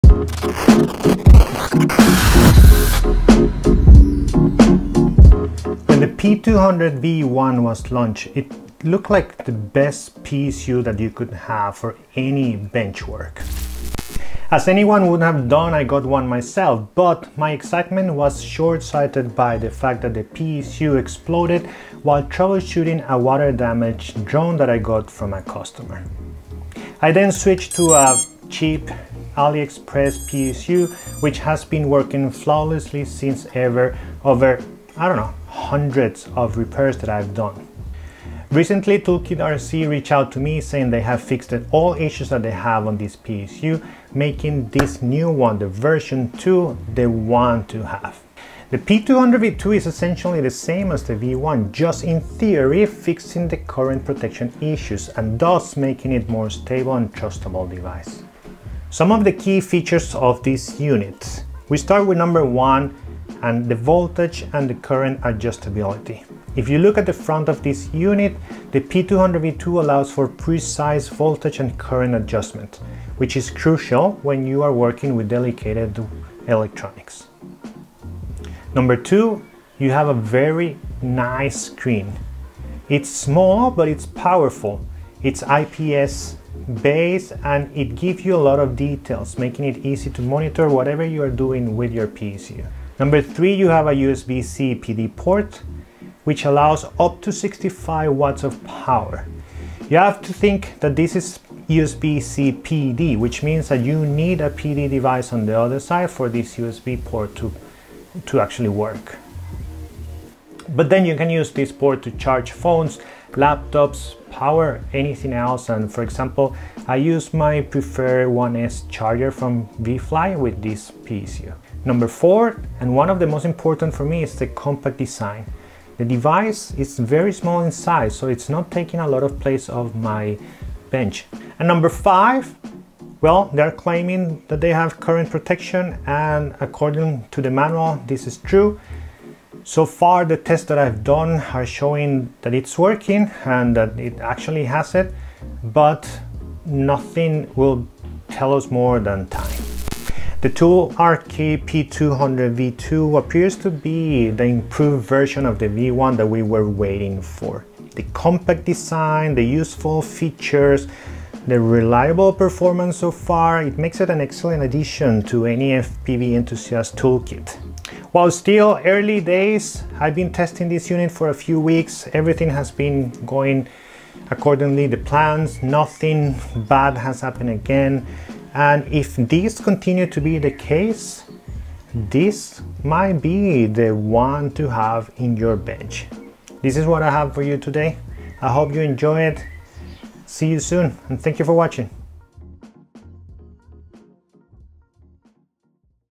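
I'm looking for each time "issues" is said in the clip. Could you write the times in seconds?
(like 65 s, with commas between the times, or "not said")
41 s, 54 s.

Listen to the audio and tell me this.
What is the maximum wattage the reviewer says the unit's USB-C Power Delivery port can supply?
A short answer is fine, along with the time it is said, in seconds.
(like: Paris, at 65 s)
65 watts, at 97 s.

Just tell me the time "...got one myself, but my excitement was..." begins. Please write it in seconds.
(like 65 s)
15 s.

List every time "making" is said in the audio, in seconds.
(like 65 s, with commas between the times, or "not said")
44 s, 55 s, 89 s.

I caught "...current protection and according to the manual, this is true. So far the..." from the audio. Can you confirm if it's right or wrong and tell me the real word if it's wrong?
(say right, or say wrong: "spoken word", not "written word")
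right.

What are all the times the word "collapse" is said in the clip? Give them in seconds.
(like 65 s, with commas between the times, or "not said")
not said.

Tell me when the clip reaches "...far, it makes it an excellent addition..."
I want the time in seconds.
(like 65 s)
163 s.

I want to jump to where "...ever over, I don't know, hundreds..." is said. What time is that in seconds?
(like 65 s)
33 s.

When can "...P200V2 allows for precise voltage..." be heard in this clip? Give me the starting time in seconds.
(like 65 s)
68 s.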